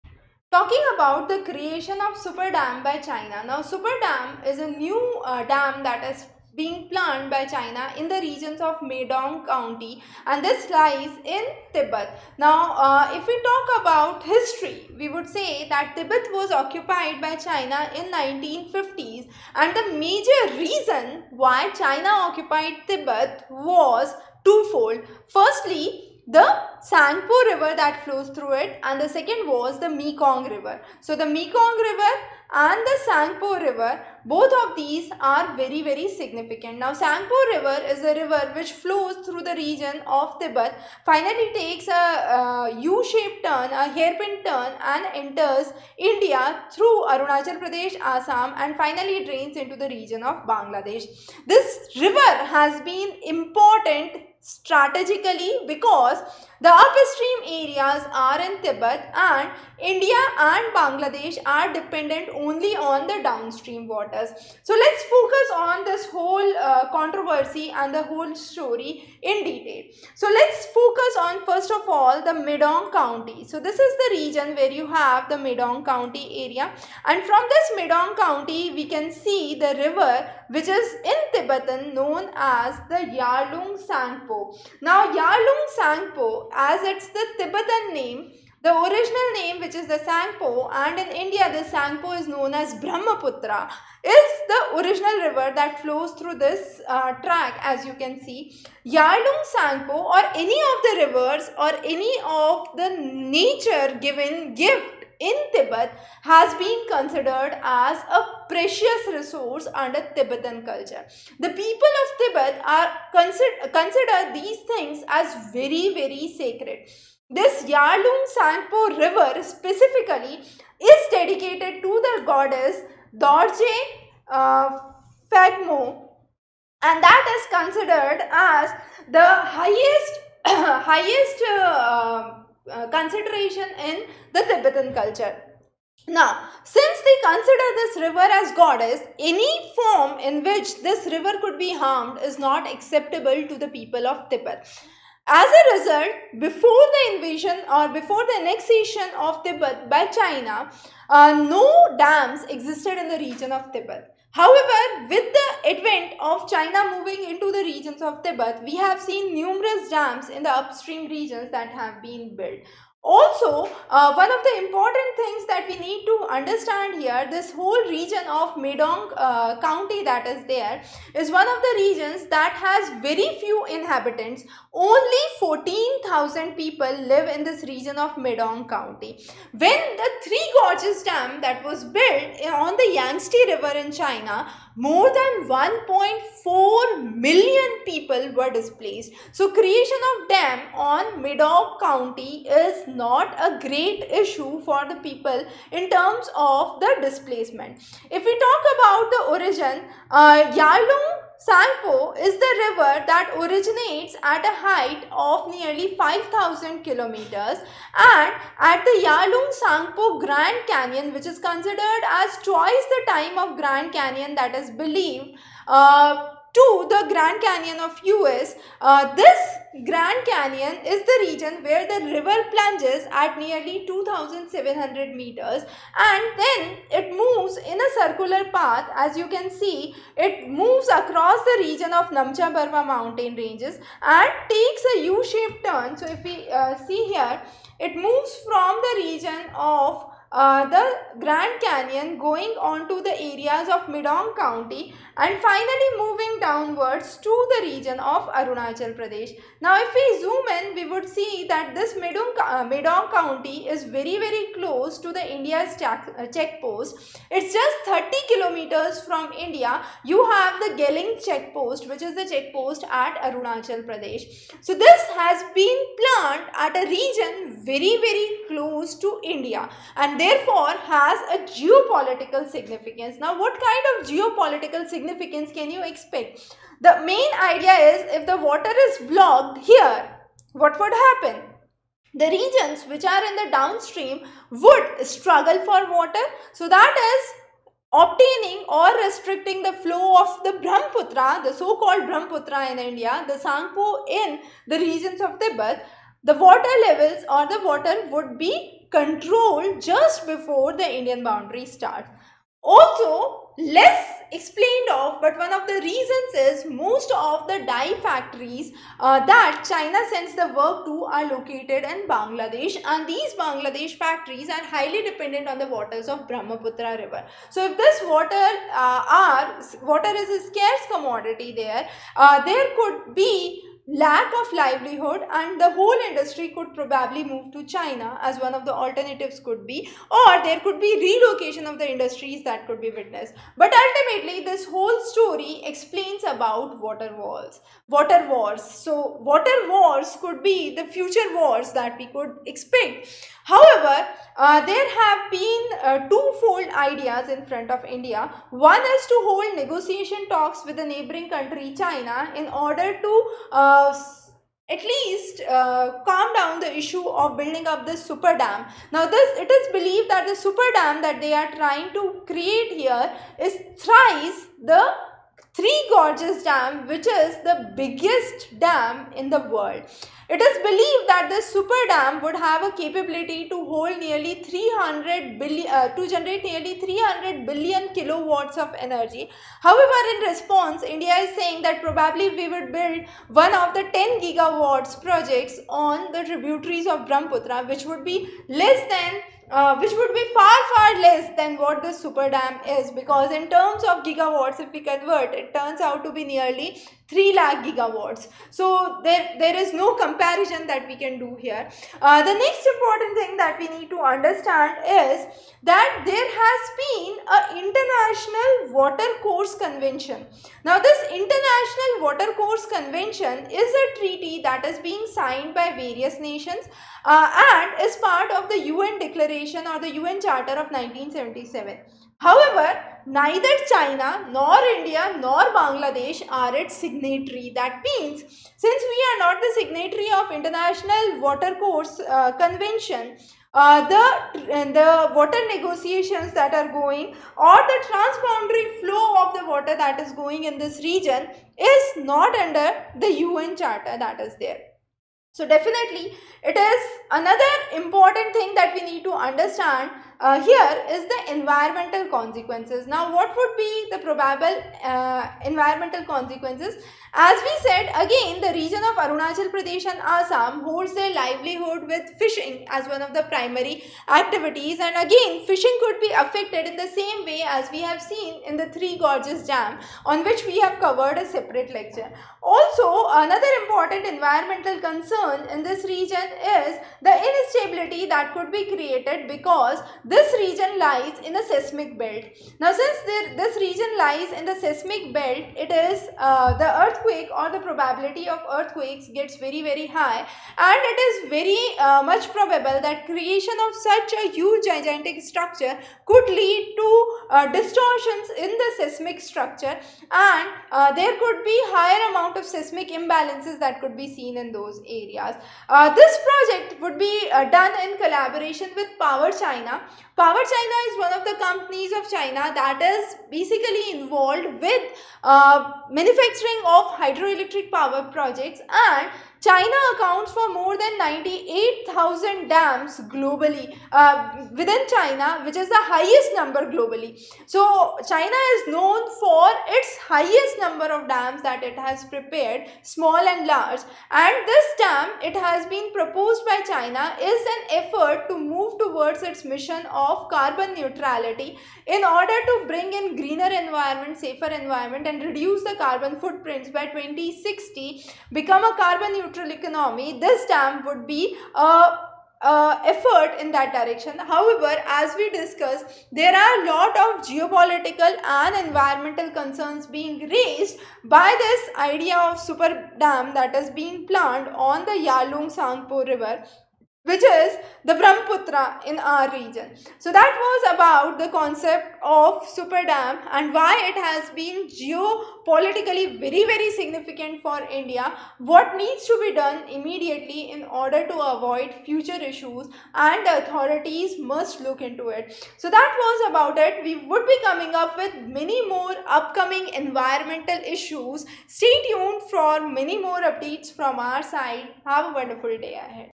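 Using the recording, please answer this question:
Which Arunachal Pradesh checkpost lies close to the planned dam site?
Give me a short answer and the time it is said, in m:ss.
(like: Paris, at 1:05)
Geling, at 4:20.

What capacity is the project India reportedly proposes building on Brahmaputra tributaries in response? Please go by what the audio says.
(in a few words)
10 gigawatts.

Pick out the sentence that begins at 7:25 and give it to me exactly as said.
So definitely it is another important thing that we need to understand uh, here is the environmental consequences.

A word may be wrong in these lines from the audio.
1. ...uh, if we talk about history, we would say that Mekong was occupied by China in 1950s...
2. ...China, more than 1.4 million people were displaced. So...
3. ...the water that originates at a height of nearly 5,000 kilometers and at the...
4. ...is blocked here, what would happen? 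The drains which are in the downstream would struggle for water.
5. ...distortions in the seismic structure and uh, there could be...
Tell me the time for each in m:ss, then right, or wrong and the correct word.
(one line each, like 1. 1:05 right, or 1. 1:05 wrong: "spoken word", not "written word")
1. 0:12 wrong: "Tibet", not "Mekong"
2. 3:03 right
3. 3:22 wrong: "river", not "water"
4. 4:38 wrong: "regions", not "drains"
5. 8:17 right.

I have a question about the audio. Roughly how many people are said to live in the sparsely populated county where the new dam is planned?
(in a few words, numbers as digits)
14,000.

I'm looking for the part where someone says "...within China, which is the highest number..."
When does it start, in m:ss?
8:44.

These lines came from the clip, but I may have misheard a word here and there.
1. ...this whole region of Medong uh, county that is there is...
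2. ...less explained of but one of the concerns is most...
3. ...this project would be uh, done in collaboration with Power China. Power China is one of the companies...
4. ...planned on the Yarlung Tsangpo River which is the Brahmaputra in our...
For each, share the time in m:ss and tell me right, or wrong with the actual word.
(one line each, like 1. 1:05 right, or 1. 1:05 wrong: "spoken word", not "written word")
1. 2:47 right
2. 5:03 wrong: "reasons", not "concerns"
3. 8:25 right
4. 9:24 right.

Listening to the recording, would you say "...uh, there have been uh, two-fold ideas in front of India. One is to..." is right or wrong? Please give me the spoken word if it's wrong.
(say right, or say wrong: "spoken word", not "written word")
right.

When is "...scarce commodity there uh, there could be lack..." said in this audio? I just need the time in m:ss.
5:20.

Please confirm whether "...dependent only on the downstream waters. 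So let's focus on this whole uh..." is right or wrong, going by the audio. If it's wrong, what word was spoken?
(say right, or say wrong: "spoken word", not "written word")
right.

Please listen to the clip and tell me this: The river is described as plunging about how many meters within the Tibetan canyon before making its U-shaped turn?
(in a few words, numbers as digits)
2700 meters.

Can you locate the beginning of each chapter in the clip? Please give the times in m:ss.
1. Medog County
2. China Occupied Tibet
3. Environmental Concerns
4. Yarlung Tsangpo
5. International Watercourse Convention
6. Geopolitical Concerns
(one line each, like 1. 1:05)
1. 1:14
2. 0:25
3. 7:35
4. 1:31
5. 6:51
6. 9:23.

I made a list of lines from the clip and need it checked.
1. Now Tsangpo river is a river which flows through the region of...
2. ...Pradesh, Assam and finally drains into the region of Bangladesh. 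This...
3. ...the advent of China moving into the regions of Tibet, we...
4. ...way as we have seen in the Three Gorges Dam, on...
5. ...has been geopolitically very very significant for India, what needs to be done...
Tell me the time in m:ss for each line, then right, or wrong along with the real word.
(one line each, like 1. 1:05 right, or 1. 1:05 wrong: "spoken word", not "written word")
1. 0:36 right
2. 0:47 right
3. 2:35 right
4. 7:47 right
5. 9:33 right.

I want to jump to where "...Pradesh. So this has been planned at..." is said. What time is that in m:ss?
4:23.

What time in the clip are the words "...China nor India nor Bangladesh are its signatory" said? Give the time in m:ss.
7:03.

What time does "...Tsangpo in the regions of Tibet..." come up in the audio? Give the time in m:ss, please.
4:53.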